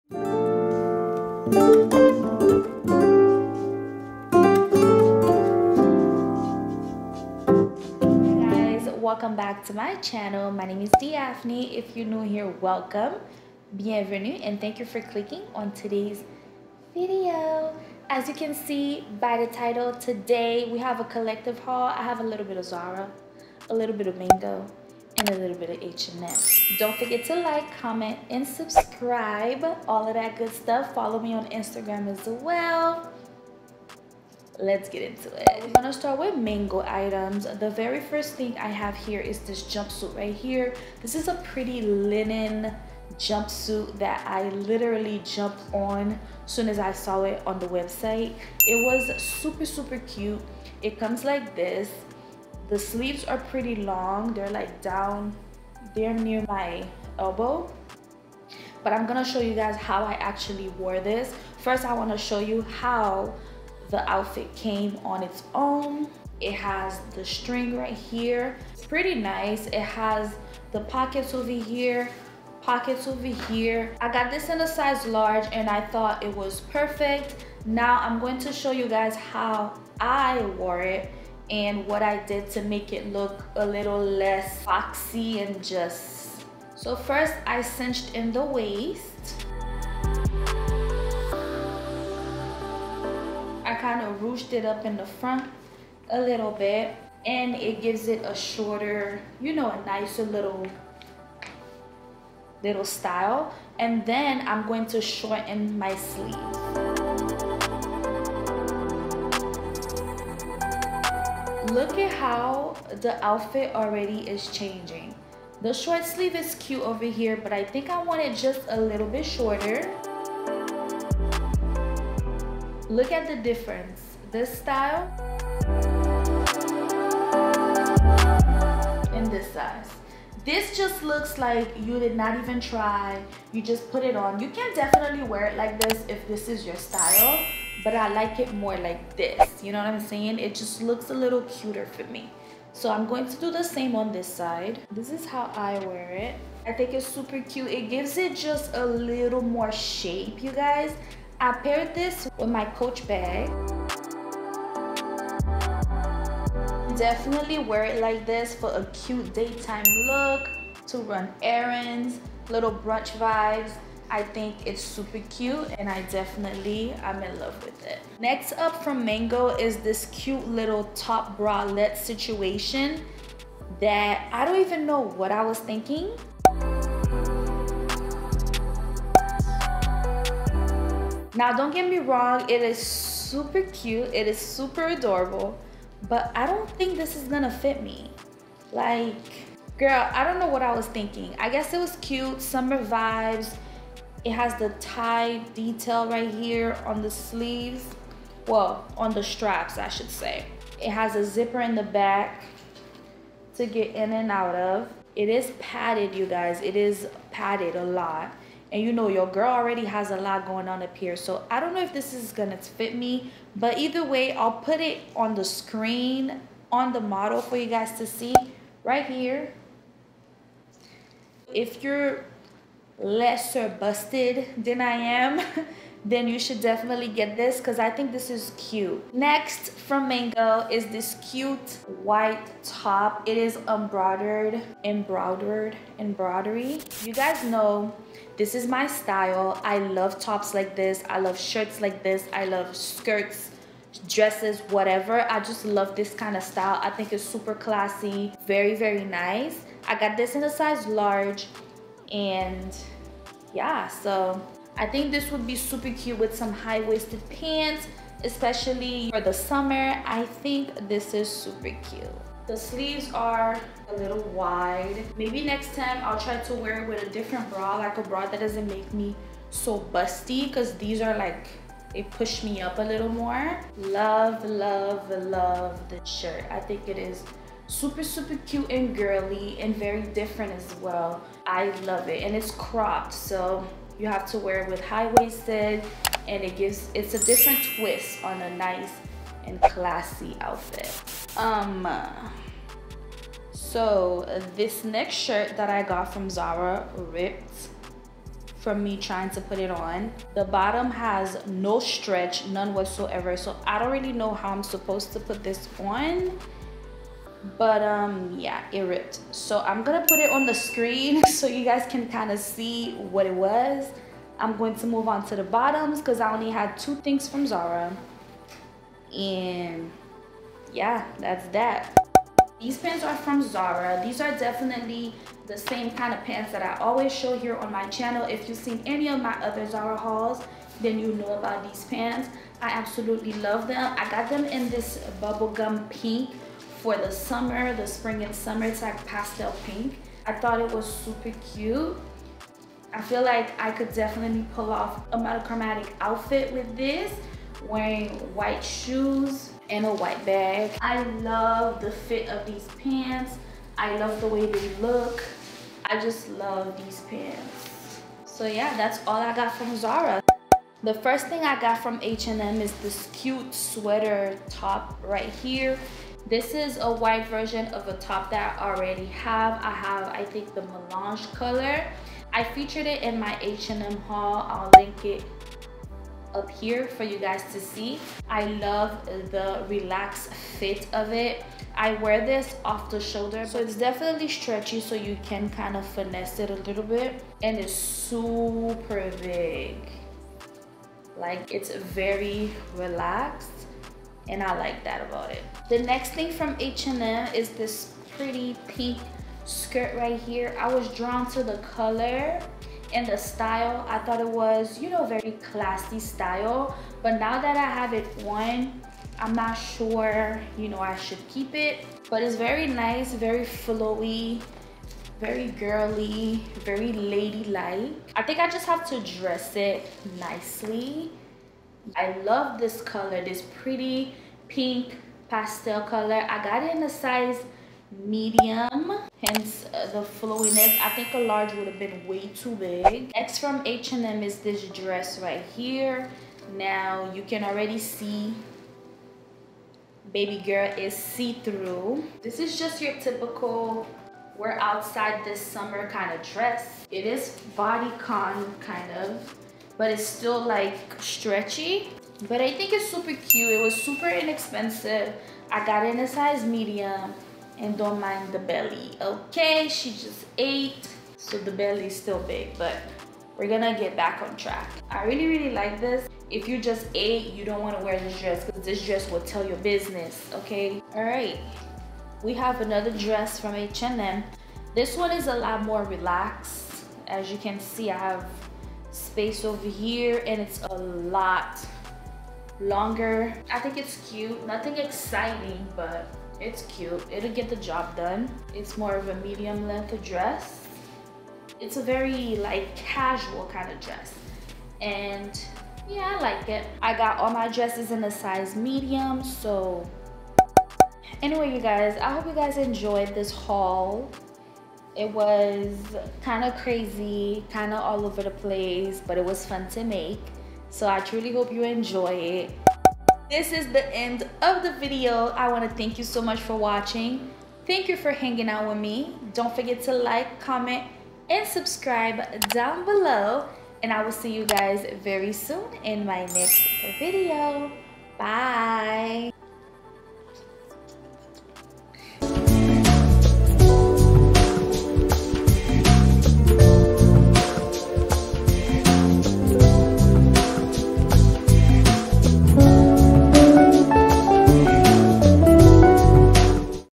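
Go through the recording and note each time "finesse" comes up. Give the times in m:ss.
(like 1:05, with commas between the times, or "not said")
6:25.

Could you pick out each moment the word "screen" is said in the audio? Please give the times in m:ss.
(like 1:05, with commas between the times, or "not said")
3:35, 5:10.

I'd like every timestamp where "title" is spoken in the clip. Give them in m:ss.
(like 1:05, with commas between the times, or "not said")
0:19.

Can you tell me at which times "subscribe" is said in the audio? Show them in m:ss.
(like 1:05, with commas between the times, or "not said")
0:28, 8:41.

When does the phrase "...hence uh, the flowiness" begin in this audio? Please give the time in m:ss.
7:09.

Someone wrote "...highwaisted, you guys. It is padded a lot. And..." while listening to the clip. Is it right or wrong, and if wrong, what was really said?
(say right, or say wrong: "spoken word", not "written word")
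wrong: "padded", not "highwaisted".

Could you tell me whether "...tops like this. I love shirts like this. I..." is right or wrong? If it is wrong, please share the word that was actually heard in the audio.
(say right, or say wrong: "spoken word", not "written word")
right.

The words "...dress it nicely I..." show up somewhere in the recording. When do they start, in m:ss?
6:59.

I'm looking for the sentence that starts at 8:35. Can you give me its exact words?
I want to thank you so much for watching.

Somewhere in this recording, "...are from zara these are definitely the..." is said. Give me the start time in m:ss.
5:23.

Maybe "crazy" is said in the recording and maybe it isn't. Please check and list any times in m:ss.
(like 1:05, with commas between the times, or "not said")
8:26.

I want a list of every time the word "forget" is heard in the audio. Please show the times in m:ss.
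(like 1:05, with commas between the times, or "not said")
0:26, 8:39.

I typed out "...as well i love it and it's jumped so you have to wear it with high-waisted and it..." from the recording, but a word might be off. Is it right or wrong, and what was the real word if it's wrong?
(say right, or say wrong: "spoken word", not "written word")
wrong: "cropped", not "jumped".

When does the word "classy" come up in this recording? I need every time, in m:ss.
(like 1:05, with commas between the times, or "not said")
4:07, 4:49, 6:45.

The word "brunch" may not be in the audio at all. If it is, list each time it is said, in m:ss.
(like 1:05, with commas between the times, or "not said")
2:42.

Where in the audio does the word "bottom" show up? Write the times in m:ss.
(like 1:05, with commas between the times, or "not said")
5:00, 5:15.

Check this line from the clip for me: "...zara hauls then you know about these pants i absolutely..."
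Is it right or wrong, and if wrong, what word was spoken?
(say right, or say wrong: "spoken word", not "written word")
right.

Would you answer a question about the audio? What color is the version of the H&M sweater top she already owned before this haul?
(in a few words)
melange.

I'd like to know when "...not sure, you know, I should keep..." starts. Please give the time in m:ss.
6:49.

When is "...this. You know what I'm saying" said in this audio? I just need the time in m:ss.
2:19.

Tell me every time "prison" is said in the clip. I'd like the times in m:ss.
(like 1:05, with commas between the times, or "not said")
not said.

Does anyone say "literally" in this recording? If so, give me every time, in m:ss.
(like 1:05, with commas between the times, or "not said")
0:44.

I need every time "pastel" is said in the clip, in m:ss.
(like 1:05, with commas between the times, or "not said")
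5:39, 7:05.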